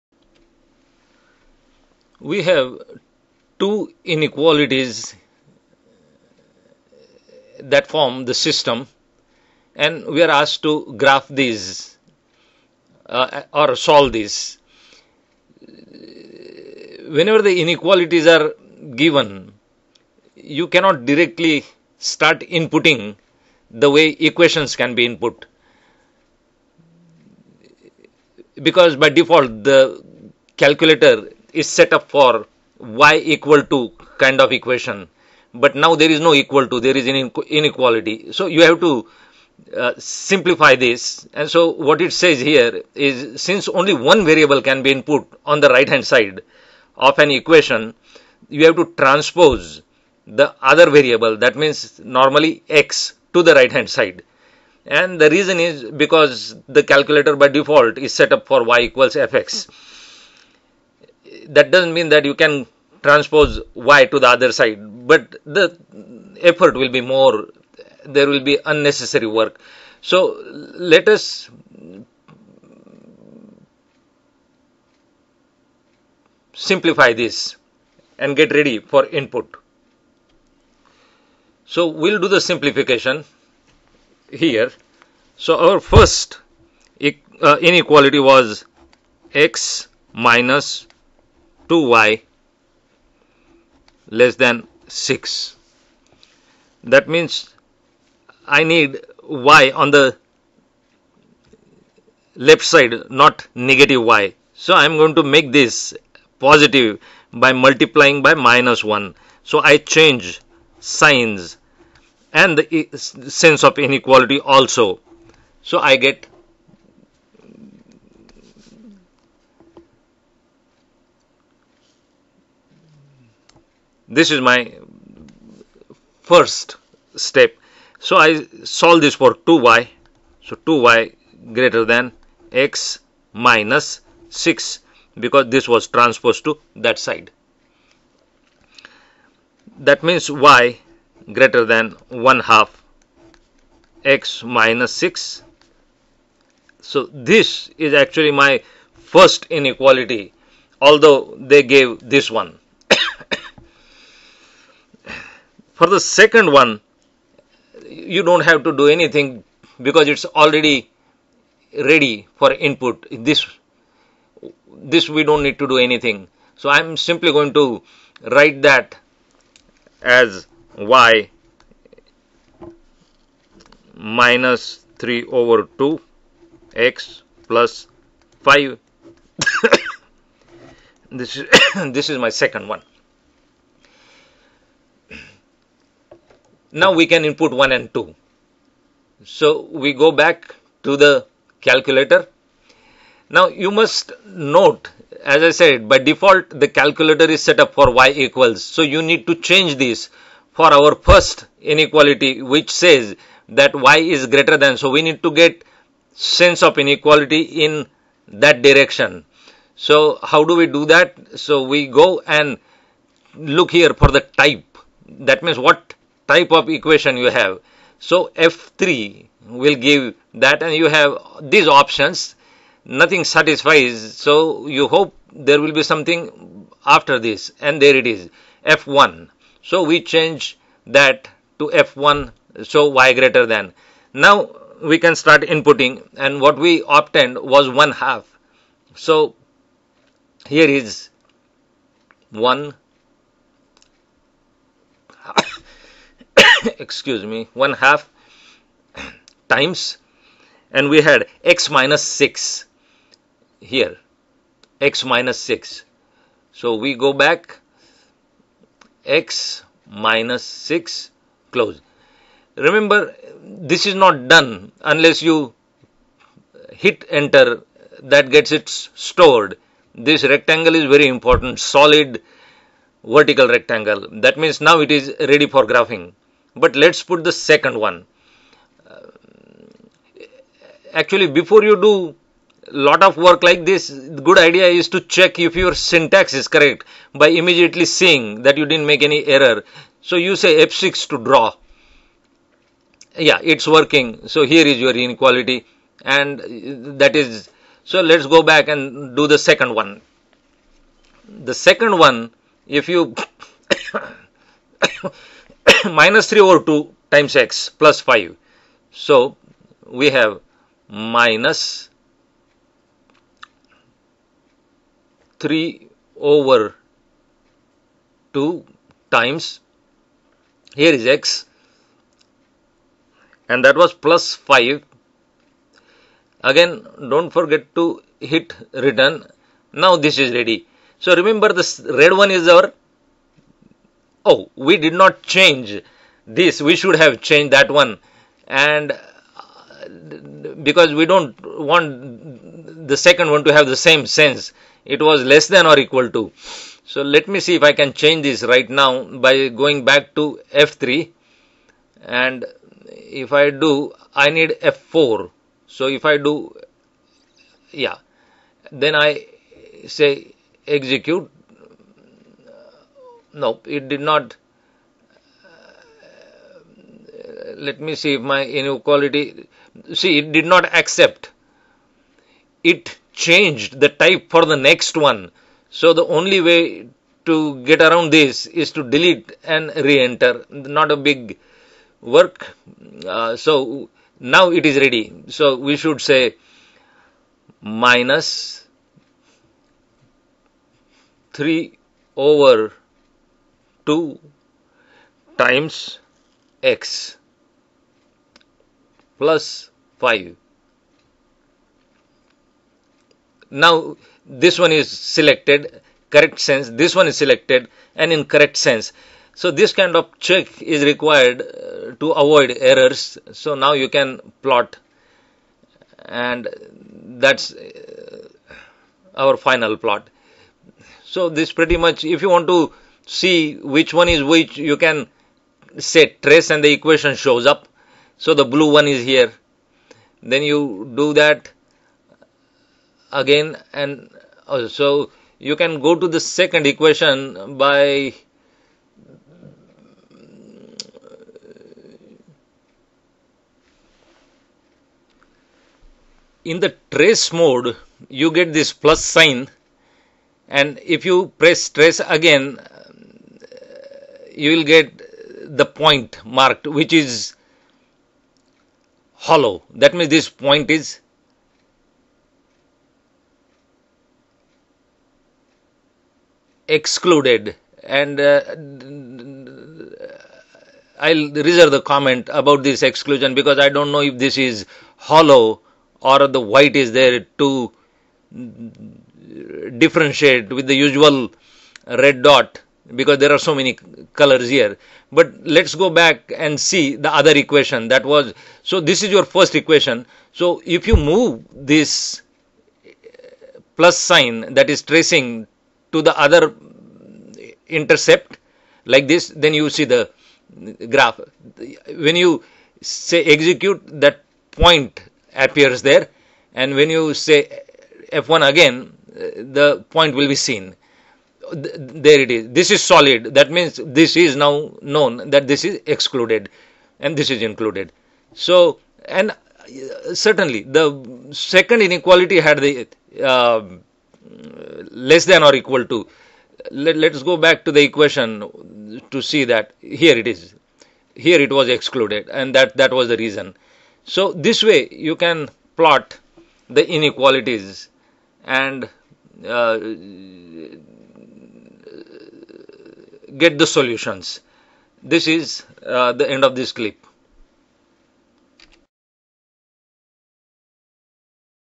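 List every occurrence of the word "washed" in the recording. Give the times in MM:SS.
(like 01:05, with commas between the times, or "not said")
not said.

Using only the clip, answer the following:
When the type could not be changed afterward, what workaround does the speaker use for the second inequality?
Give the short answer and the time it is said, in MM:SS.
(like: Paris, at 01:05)
delete and re-enter, at 06:18.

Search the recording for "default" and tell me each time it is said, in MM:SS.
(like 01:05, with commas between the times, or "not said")
00:29, 00:57, 03:15.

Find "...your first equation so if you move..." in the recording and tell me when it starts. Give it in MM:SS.
08:09.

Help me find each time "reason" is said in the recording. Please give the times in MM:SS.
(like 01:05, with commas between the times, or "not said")
00:55, 08:53.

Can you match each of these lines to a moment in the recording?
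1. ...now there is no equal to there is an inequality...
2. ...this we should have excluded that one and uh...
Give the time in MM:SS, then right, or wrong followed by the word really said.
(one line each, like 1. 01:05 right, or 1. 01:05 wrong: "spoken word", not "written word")
1. 00:35 right
2. 05:36 wrong: "changed", not "excluded".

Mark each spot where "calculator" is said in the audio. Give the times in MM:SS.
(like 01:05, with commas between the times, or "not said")
00:30, 00:56, 03:11, 03:16.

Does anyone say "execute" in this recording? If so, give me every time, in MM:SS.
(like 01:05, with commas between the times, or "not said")
06:00, 08:23.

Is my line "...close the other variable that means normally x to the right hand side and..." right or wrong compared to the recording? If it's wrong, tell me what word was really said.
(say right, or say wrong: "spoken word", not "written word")
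wrong: "transpose", not "close".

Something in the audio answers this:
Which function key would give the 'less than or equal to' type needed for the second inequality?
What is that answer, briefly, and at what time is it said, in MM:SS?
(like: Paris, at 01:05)
F4, at 05:54.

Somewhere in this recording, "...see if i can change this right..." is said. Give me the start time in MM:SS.
05:47.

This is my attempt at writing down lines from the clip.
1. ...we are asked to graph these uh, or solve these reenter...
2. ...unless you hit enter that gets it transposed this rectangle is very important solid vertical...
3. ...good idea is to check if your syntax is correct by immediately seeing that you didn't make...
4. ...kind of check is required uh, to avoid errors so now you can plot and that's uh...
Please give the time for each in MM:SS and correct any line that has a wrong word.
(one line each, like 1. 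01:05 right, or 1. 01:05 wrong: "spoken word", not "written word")
1. 00:10 wrong: "whenever", not "reenter"
2. 04:24 wrong: "stored", not "transposed"
3. 04:43 right
4. 06:49 right.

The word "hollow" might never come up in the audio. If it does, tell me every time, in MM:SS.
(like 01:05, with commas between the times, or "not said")
07:39, 07:54.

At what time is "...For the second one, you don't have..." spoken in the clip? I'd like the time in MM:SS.
02:35.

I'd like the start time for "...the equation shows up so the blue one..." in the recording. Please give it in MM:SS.
07:06.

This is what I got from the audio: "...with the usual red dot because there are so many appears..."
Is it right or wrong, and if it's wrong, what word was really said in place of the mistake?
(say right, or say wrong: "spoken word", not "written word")
wrong: "colors", not "appears".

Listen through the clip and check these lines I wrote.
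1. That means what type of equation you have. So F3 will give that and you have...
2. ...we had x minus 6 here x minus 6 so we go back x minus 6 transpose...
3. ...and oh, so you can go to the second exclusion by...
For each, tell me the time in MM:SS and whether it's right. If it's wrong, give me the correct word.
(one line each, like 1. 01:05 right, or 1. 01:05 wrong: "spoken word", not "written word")
1. 03:35 right
2. 04:10 wrong: "close", not "transpose"
3. 07:13 wrong: "equation", not "exclusion".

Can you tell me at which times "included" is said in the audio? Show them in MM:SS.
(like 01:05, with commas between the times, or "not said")
08:37.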